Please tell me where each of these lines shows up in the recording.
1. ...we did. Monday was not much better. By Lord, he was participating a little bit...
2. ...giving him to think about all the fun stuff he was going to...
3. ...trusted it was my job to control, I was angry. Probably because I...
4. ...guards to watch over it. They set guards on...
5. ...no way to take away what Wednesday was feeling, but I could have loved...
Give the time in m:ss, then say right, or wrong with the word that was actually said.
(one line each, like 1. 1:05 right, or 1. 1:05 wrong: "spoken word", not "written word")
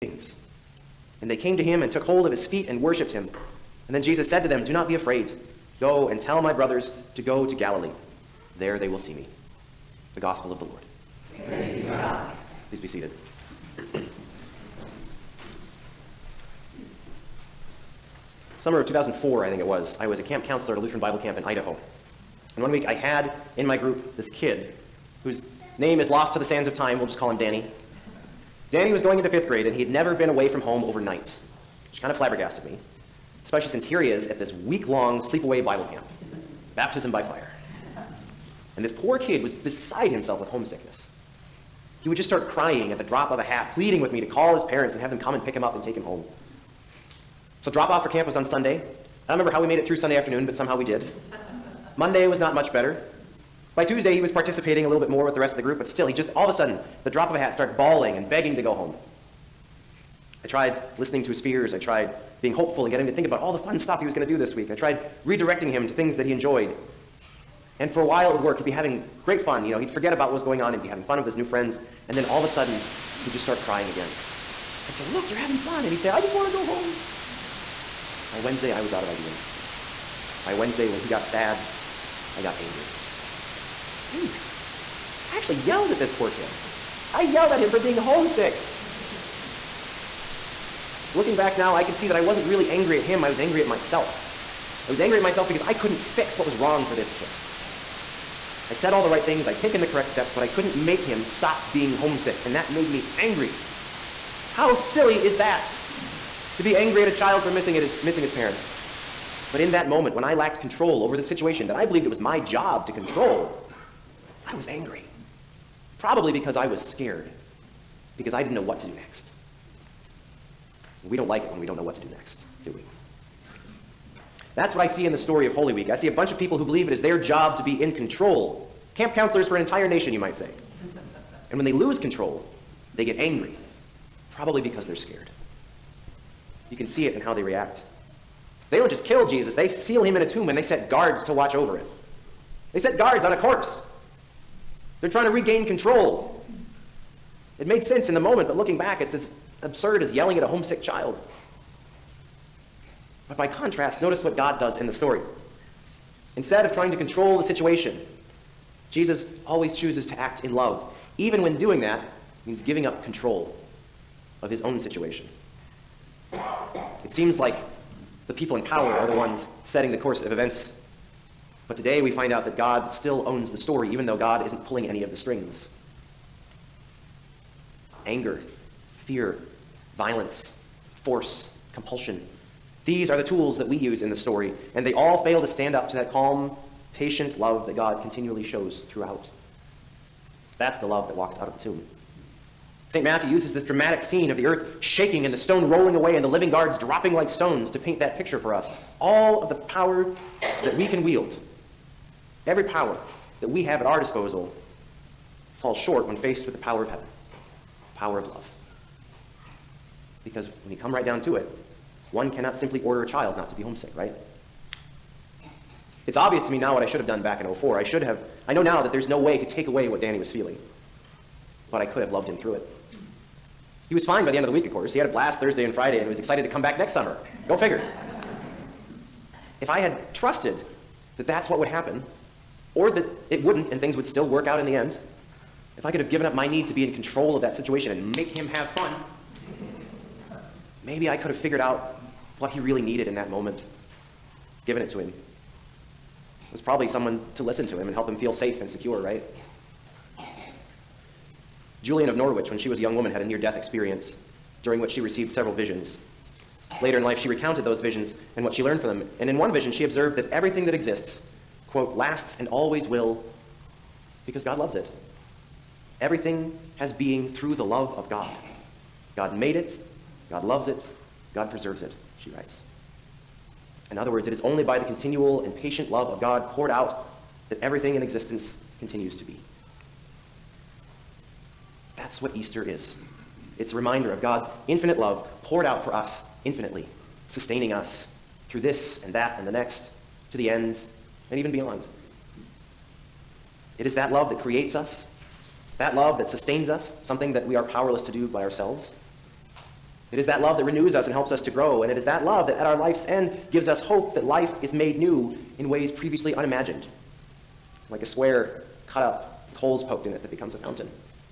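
1. 0:50 wrong: "Tuesday", not "Lord"
2. 1:02 wrong: "getting", not "giving"
3. 1:51 wrong: "believed", not "trusted"
4. 2:20 right
5. 3:39 wrong: "Danny", not "Wednesday".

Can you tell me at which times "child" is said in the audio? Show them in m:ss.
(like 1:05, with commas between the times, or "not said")
1:47, 2:30, 3:33.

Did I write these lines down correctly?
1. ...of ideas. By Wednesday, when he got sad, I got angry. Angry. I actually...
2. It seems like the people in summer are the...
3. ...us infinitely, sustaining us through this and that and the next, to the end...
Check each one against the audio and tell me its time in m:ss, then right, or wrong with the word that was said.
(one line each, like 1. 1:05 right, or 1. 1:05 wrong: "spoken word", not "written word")
1. 1:19 right
2. 2:46 wrong: "power", not "summer"
3. 4:45 right.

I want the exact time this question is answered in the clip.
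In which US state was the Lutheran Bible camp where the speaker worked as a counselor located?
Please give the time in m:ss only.
0:21.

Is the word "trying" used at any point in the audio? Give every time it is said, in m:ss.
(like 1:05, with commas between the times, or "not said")
2:25, 2:36.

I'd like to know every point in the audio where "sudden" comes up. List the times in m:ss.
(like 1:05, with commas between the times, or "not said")
0:56, 1:12.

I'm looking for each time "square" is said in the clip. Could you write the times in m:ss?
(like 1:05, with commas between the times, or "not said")
5:08.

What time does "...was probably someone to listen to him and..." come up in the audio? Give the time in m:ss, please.
4:06.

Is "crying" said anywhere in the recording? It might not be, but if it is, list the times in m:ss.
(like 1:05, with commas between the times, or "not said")
0:42, 1:13.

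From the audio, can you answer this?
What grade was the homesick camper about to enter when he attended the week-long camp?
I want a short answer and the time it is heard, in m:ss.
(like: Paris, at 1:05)
fifth grade, at 0:29.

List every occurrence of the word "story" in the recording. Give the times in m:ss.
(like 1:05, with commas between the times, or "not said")
2:05, 2:34, 2:53, 3:04.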